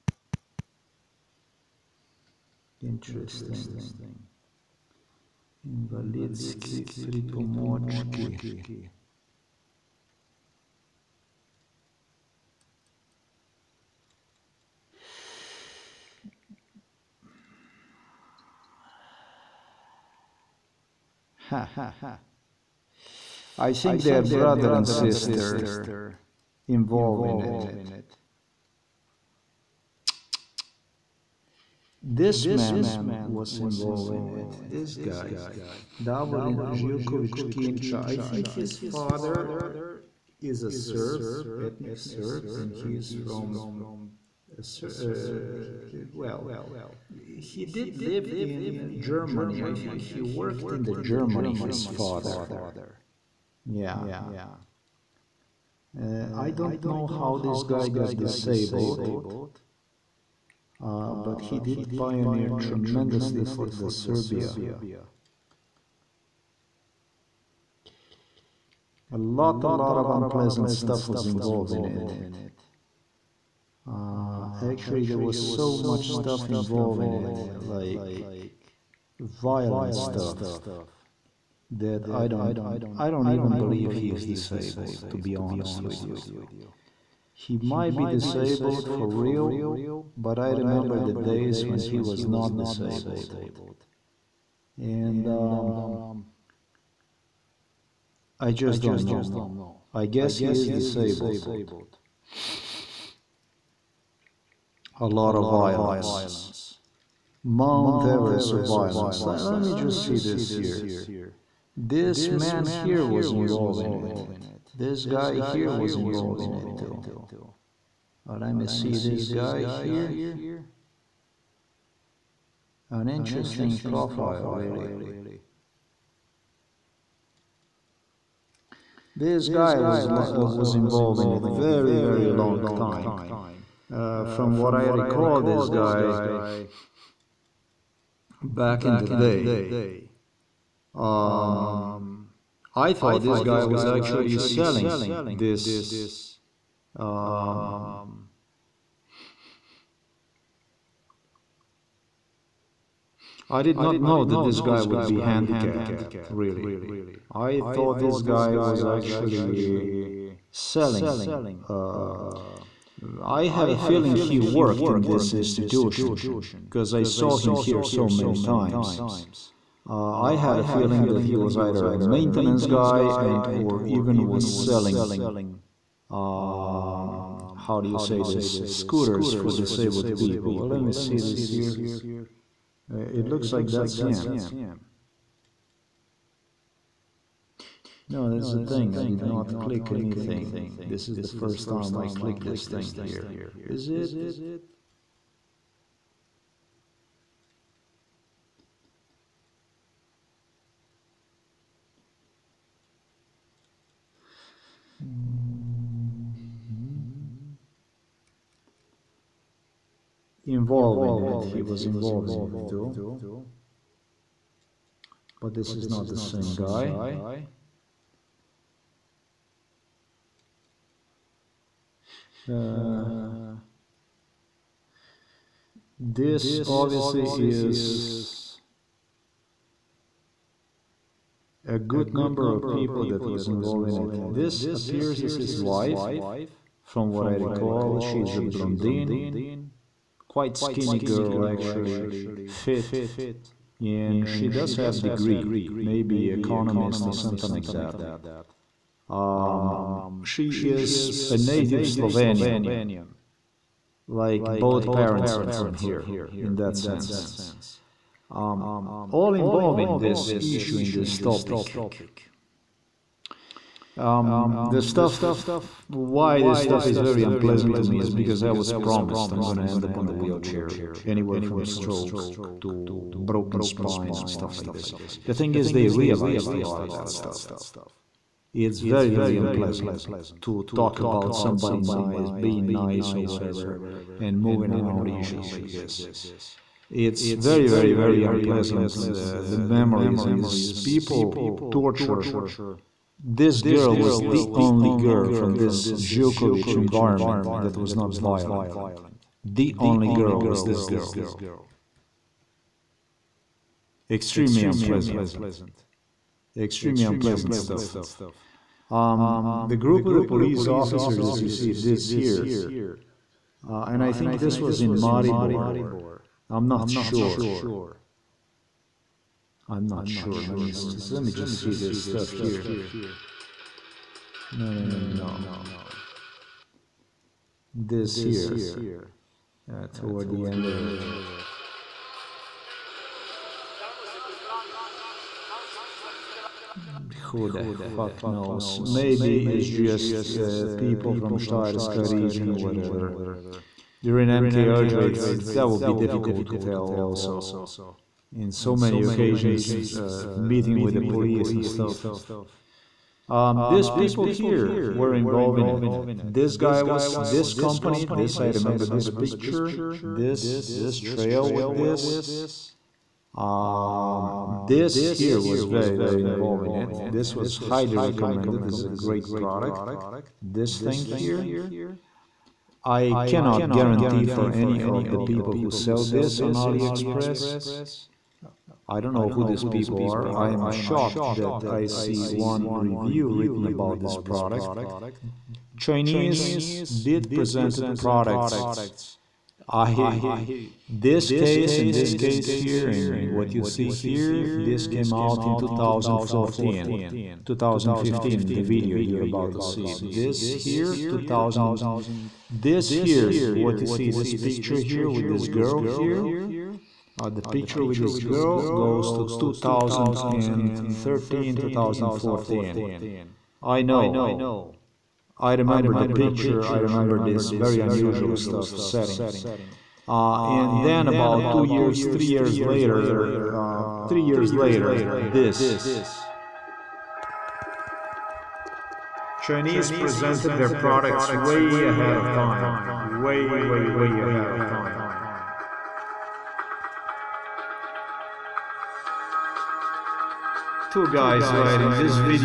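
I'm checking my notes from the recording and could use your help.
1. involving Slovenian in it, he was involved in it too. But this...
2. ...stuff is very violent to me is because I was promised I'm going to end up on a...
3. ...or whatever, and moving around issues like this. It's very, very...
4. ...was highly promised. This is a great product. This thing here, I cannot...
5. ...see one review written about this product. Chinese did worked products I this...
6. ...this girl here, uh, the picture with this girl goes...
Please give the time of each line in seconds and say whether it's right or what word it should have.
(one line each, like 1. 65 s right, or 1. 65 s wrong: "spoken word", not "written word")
1. 210 s wrong: "Involved", not "Slovenian"
2. 266 s wrong: "unpleasant", not "violent"
3. 283 s right
4. 367 s wrong: "recommended", not "promised"
5. 381 s wrong: "presented", not "worked"
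6. 405 s right.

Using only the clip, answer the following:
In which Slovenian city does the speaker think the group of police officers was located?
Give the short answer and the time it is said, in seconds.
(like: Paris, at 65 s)
Maribor, at 314 s.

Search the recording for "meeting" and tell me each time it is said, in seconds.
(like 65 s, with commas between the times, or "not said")
350 s.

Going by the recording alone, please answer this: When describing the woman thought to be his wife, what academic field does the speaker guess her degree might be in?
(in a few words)
economist.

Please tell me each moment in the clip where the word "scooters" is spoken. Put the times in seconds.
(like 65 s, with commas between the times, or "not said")
178 s.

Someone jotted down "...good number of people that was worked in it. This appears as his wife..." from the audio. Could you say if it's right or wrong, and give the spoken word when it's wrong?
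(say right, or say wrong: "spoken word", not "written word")
wrong: "involved", not "worked".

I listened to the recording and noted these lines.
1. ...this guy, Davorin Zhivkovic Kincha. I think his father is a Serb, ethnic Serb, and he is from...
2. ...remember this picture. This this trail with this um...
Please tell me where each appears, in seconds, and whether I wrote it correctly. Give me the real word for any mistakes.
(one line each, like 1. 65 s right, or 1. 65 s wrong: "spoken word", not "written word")
1. 34 s right
2. 358 s right.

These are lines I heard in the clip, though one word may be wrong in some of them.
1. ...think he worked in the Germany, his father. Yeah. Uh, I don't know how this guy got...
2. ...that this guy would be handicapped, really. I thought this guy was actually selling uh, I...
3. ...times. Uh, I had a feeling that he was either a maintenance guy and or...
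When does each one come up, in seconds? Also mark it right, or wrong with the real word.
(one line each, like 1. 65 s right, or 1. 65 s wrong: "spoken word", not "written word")
1. 49 s right
2. 154 s right
3. 168 s right.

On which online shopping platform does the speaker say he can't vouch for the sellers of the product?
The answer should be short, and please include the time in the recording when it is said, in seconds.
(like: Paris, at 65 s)
AliExpress, at 376 s.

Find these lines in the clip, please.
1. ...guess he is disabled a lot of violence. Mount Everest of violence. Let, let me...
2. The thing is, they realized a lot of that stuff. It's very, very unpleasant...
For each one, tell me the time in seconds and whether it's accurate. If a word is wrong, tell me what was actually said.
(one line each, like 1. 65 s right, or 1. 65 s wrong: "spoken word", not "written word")
1. 100 s right
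2. 275 s right.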